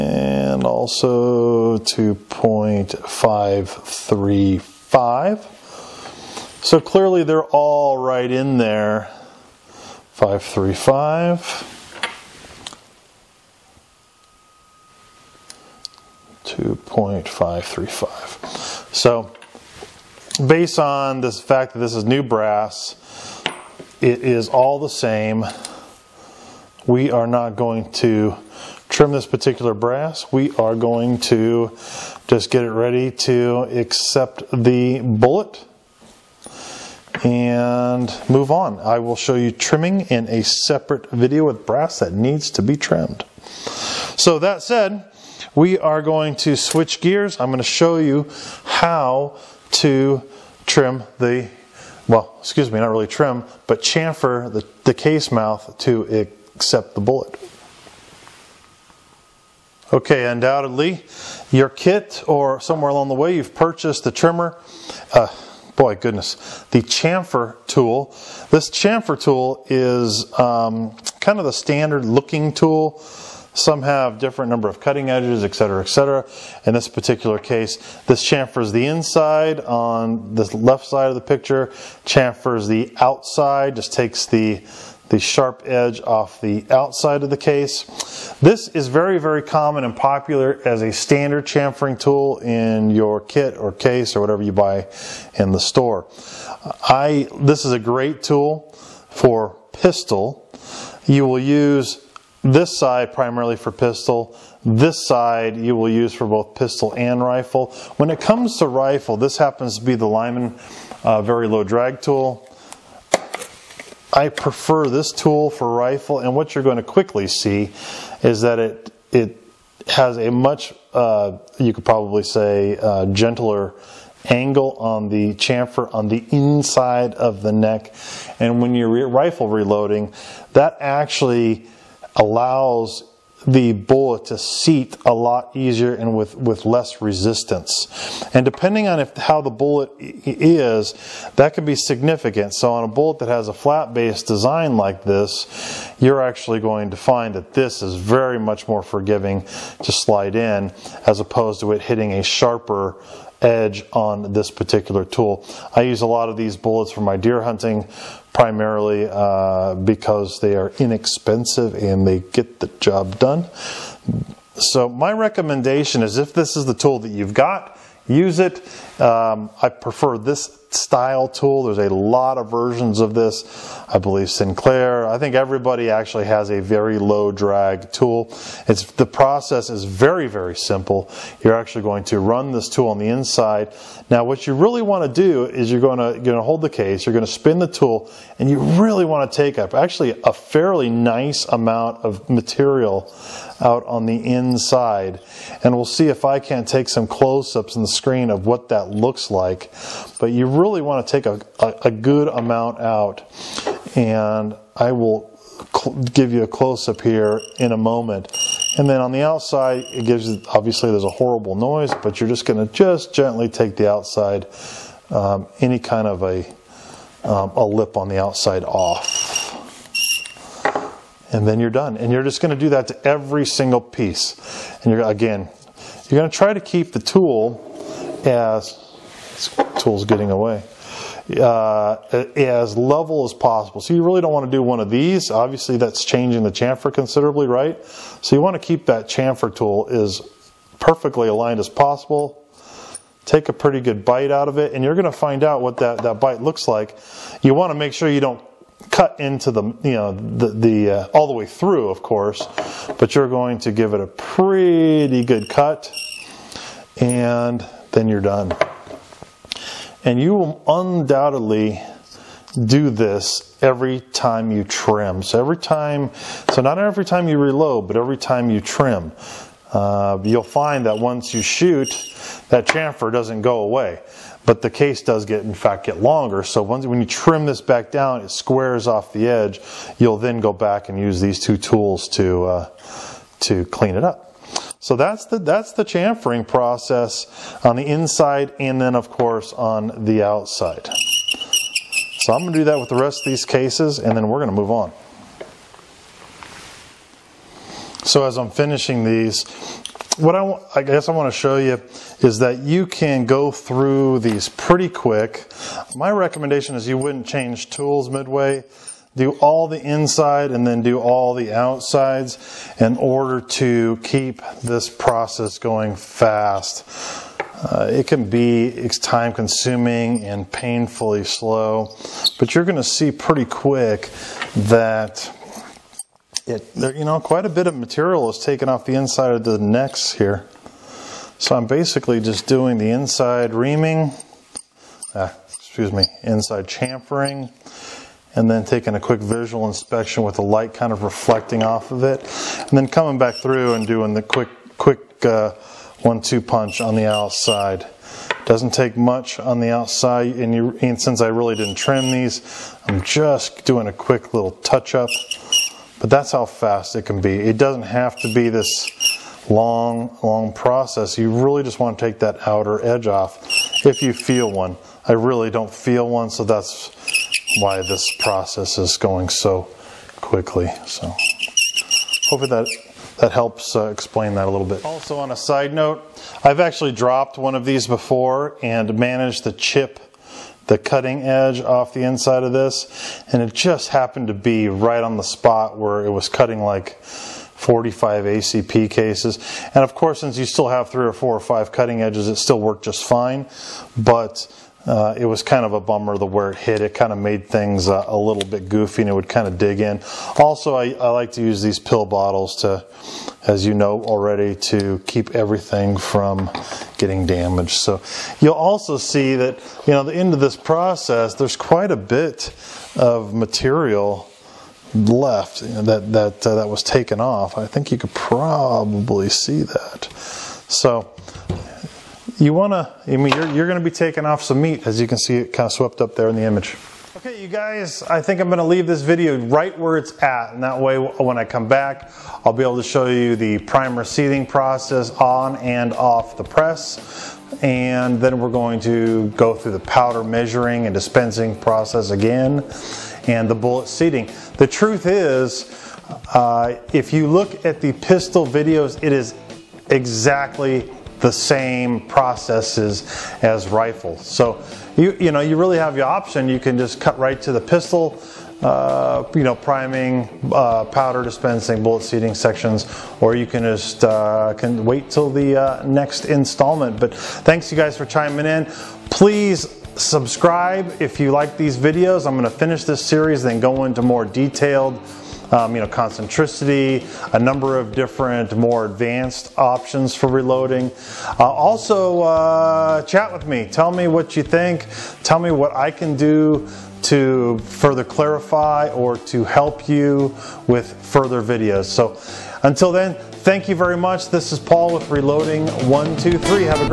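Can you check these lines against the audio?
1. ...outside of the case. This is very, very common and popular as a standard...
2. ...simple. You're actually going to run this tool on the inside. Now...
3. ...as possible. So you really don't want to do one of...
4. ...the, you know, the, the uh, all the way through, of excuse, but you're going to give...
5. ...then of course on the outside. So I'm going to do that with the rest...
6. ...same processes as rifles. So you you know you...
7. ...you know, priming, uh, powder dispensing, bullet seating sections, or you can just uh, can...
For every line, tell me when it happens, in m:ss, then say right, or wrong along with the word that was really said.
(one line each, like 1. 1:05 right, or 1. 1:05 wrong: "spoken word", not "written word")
1. 1:26 right
2. 3:00 right
3. 3:53 right
4. 4:09 wrong: "course", not "excuse"
5. 4:48 right
6. 7:31 right
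7. 7:39 right.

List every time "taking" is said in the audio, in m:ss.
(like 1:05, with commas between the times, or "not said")
5:38, 7:03.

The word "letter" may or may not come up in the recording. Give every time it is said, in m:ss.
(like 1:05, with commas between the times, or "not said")
not said.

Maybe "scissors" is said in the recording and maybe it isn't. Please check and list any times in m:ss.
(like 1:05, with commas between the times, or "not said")
not said.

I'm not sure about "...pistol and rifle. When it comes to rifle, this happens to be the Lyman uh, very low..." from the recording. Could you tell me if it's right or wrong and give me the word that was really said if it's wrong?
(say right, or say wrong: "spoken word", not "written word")
right.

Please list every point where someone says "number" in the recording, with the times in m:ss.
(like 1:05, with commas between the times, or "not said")
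1:14, 7:57.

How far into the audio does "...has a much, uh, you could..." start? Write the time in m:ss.
1:59.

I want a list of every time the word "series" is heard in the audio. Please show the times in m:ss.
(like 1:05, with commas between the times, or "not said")
7:53.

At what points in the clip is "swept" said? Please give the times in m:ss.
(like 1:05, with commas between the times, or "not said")
7:05.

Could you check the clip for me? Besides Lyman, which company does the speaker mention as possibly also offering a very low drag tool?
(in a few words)
Sinclair.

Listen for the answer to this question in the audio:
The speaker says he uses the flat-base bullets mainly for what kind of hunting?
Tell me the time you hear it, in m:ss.
2:37.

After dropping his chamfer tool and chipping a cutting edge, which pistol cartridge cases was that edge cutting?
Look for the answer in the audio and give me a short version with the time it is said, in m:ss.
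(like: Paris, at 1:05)
45 ACP, at 6:27.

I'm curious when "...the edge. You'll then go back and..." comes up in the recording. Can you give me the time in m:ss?
4:39.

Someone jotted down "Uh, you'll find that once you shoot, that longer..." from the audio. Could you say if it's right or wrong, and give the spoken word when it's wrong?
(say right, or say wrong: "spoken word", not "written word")
wrong: "chamfer", not "longer".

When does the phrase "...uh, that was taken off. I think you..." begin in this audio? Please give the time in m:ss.
6:56.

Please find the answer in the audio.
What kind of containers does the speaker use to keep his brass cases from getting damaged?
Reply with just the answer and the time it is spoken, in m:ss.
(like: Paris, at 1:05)
pill bottles, at 6:41.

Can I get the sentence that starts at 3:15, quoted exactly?
And we'll see if I can't take some close-ups on the screen of what that that looks like.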